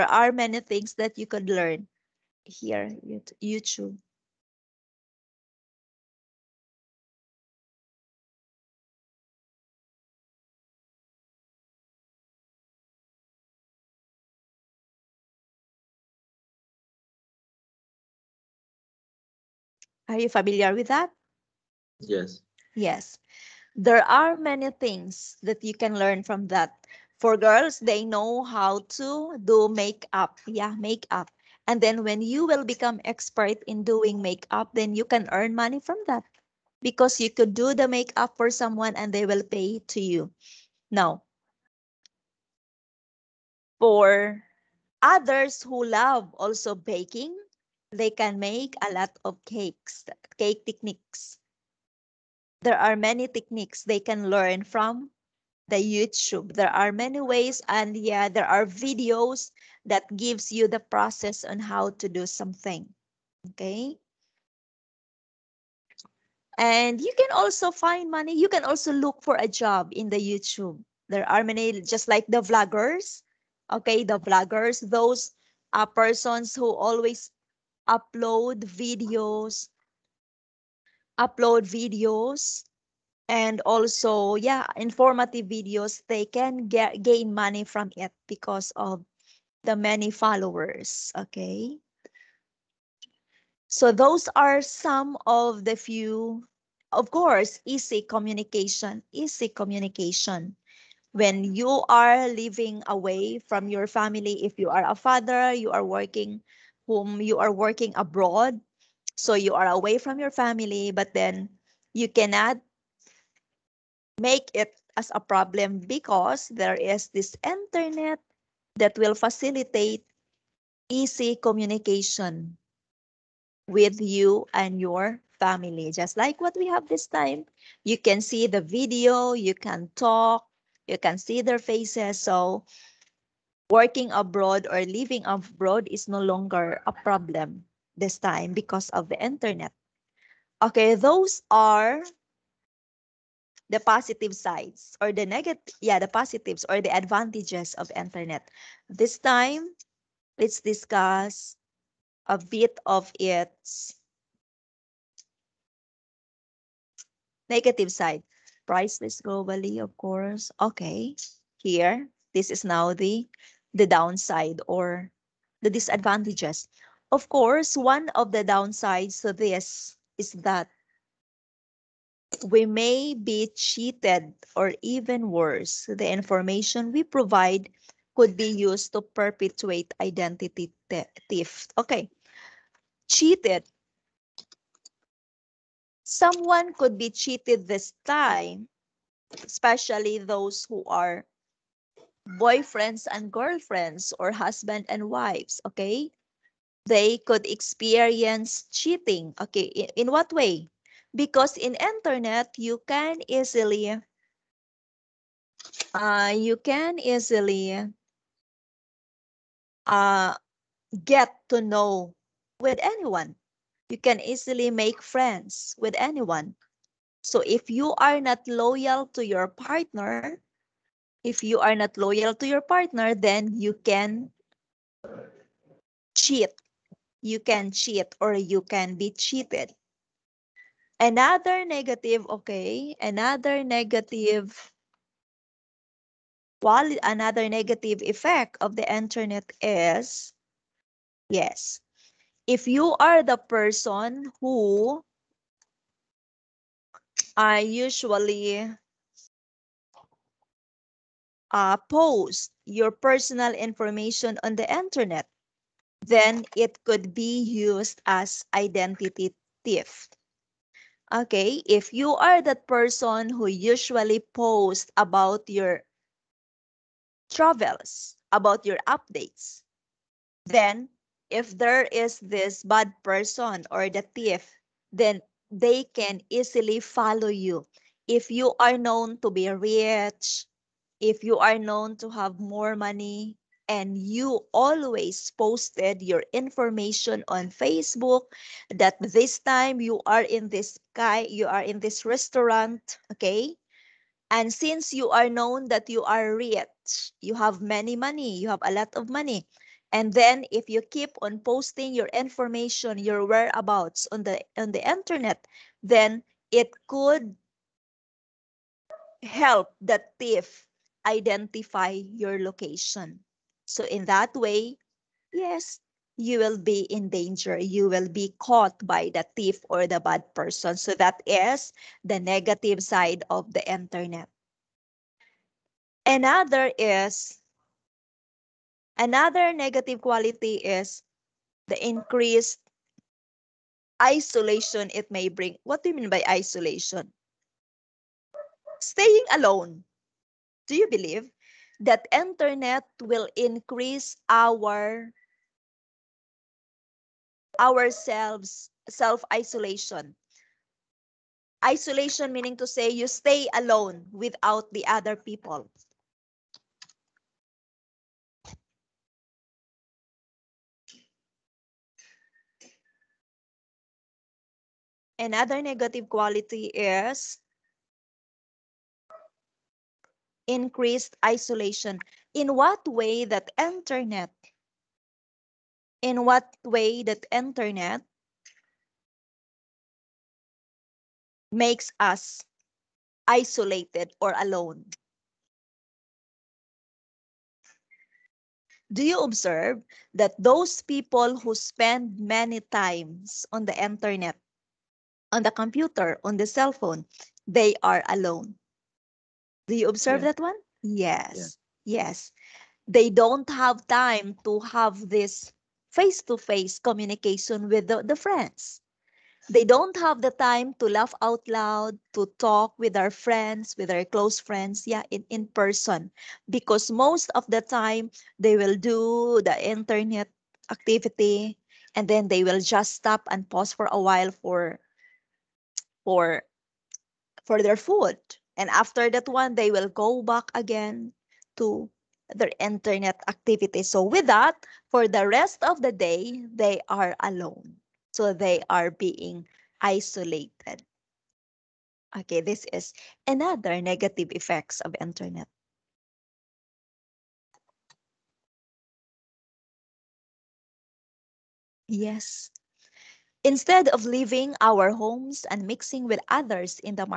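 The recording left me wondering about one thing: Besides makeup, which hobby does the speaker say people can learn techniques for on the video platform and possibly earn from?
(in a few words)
baking.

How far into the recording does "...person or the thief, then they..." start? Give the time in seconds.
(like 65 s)
273 s.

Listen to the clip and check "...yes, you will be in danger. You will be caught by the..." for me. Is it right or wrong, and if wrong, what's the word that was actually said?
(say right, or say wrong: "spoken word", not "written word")
right.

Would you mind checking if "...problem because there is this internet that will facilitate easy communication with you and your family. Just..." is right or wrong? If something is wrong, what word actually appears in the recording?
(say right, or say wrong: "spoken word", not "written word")
right.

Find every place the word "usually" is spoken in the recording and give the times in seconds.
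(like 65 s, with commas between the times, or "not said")
247 s, 263 s.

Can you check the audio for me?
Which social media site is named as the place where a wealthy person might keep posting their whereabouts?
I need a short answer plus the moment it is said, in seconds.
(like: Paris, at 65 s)
Facebook, at 287 s.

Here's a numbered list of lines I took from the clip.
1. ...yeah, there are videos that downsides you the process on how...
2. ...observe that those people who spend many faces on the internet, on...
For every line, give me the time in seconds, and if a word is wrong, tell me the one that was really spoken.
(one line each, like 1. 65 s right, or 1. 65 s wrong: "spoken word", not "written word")
1. 57 s wrong: "gives", not "downsides"
2. 389 s wrong: "times", not "faces".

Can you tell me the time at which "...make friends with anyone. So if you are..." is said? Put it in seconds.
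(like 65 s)
214 s.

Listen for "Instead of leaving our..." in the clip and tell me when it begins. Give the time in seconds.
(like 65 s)
453 s.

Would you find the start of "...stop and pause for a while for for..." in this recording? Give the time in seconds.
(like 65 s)
422 s.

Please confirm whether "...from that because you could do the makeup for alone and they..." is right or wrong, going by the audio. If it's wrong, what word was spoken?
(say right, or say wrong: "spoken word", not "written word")
wrong: "someone", not "alone".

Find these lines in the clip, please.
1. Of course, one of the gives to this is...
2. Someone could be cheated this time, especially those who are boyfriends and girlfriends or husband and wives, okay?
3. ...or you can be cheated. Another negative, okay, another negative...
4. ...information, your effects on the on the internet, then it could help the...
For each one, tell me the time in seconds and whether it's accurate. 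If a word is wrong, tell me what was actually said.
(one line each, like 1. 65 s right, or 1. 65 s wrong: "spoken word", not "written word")
1. 167 s wrong: "downsides", not "gives"
2. 186 s right
3. 228 s right
4. 302 s wrong: "whereabouts", not "effects".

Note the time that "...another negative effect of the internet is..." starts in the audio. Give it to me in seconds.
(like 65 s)
237 s.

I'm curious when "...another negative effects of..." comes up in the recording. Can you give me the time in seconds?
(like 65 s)
443 s.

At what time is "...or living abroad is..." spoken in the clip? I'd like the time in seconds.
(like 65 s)
134 s.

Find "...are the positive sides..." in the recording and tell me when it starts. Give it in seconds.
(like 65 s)
141 s.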